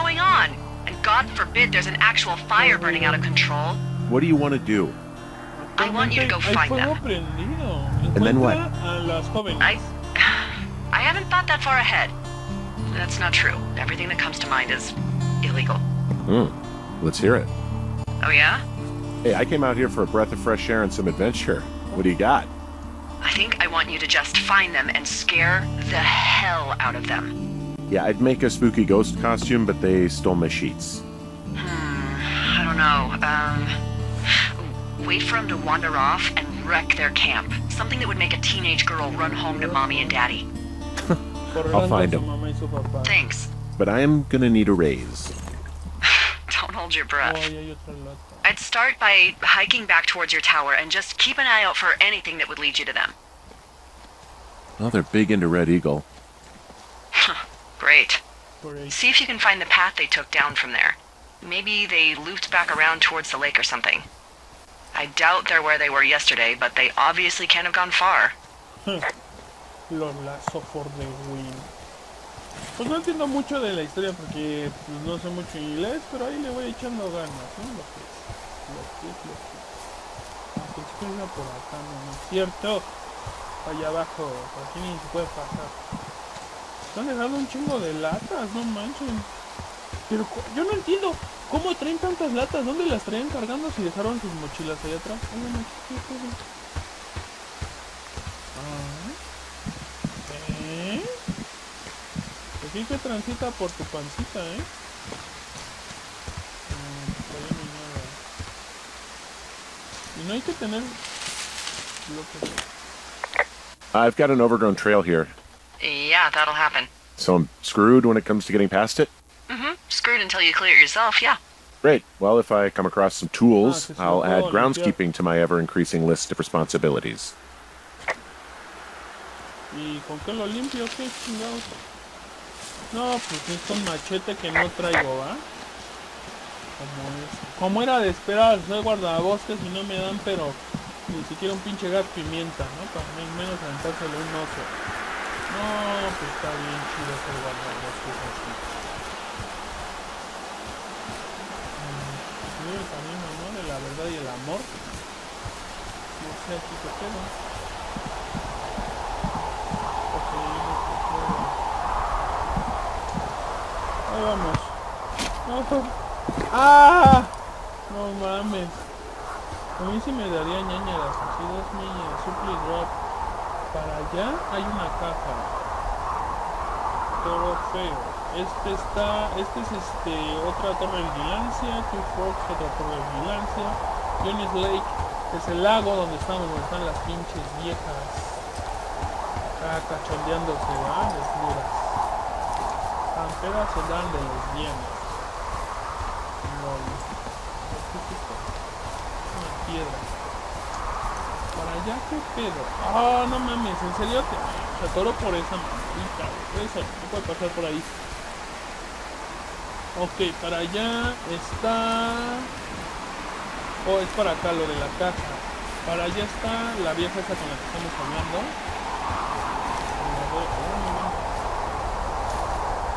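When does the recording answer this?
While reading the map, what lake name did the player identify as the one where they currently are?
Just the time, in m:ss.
3:04.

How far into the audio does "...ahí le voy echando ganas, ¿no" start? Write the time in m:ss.
1:16.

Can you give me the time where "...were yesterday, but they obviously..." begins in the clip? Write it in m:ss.
1:05.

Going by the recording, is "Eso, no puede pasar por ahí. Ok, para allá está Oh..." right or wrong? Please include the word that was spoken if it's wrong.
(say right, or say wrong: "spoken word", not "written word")
right.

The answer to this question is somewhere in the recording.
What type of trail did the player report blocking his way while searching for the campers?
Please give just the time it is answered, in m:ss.
1:54.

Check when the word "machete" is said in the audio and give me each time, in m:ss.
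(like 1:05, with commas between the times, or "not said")
2:13.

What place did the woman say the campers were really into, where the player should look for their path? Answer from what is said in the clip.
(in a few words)
Red Eagle.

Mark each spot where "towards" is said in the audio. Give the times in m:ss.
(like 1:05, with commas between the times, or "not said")
0:50, 1:03.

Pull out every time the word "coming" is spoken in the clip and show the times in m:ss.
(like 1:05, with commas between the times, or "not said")
not said.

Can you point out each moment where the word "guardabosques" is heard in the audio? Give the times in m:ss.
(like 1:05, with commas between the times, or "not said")
2:18, 2:27.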